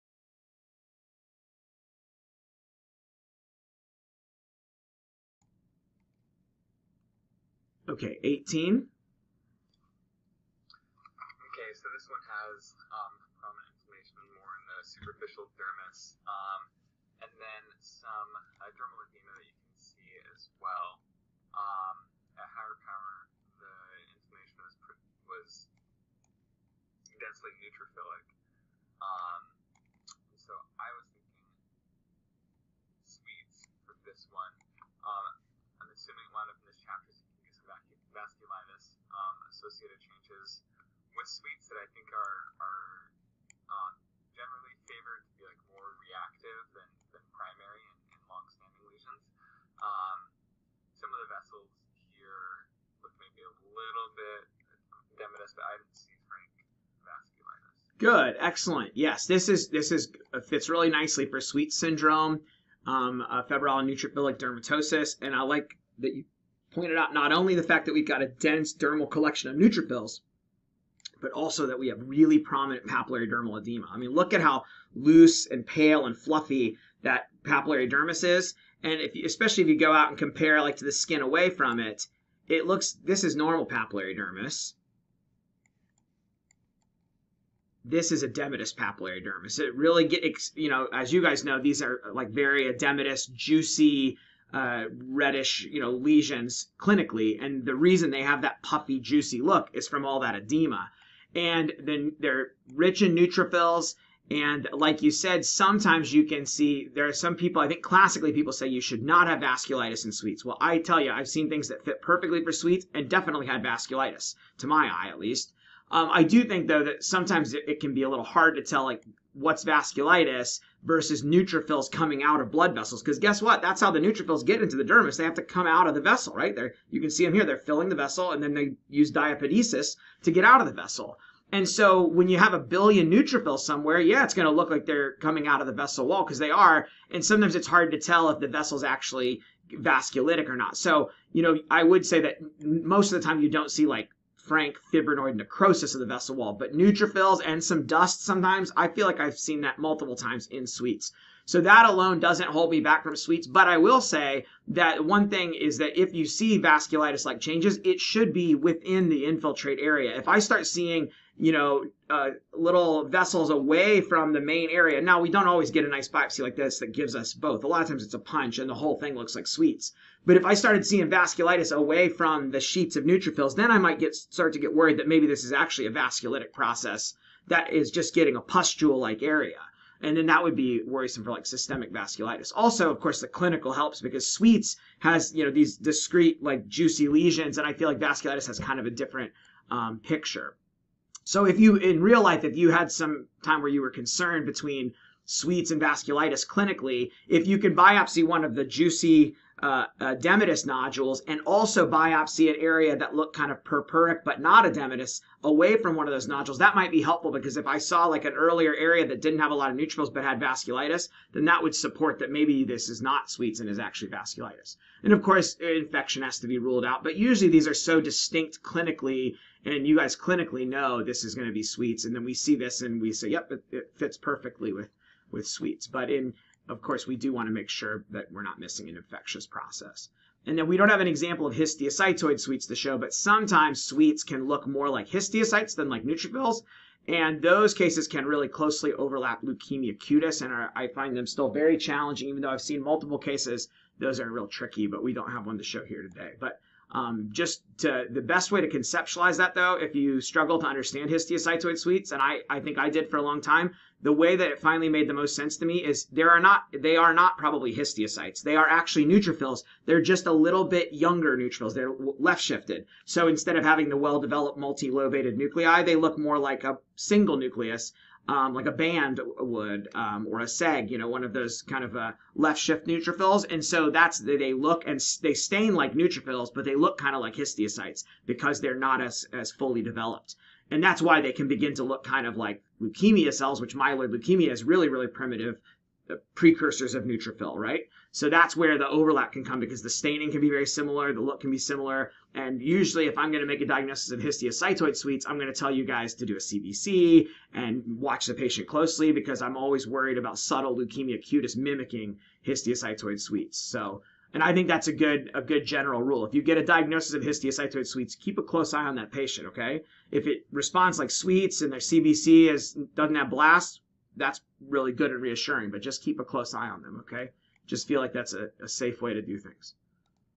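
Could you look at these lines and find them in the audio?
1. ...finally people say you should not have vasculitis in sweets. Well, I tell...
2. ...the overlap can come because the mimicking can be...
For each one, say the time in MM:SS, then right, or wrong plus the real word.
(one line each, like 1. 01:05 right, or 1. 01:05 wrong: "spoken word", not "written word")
1. 01:47 wrong: "classically", not "finally"
2. 04:48 wrong: "staining", not "mimicking".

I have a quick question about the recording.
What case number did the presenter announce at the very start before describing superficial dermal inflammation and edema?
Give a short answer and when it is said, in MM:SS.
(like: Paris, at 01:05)
18, at 00:08.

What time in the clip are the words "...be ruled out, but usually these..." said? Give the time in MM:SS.
03:36.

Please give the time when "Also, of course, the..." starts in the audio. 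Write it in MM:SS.
03:02.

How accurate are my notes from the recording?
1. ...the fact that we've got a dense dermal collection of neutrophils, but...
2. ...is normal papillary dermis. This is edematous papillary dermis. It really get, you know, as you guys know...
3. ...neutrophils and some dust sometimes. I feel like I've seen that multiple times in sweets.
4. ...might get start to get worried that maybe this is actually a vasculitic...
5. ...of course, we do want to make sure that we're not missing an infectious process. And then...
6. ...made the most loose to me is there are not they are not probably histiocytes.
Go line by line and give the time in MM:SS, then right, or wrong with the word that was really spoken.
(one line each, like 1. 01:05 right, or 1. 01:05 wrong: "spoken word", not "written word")
1. 01:07 right
2. 01:23 right
3. 02:26 right
4. 02:53 right
5. 03:46 right
6. 04:14 wrong: "sense", not "loose".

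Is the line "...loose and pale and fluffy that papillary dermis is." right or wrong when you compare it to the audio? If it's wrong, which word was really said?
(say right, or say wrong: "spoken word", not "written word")
right.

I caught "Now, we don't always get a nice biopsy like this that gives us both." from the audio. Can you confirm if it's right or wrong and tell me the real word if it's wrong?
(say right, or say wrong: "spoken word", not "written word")
right.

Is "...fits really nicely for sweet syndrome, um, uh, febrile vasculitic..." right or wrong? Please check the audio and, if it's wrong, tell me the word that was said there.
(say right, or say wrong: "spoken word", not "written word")
wrong: "neutrophilic", not "vasculitic".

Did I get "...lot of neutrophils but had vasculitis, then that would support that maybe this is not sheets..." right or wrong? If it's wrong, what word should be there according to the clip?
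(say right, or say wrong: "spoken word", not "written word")
wrong: "sweets", not "sheets".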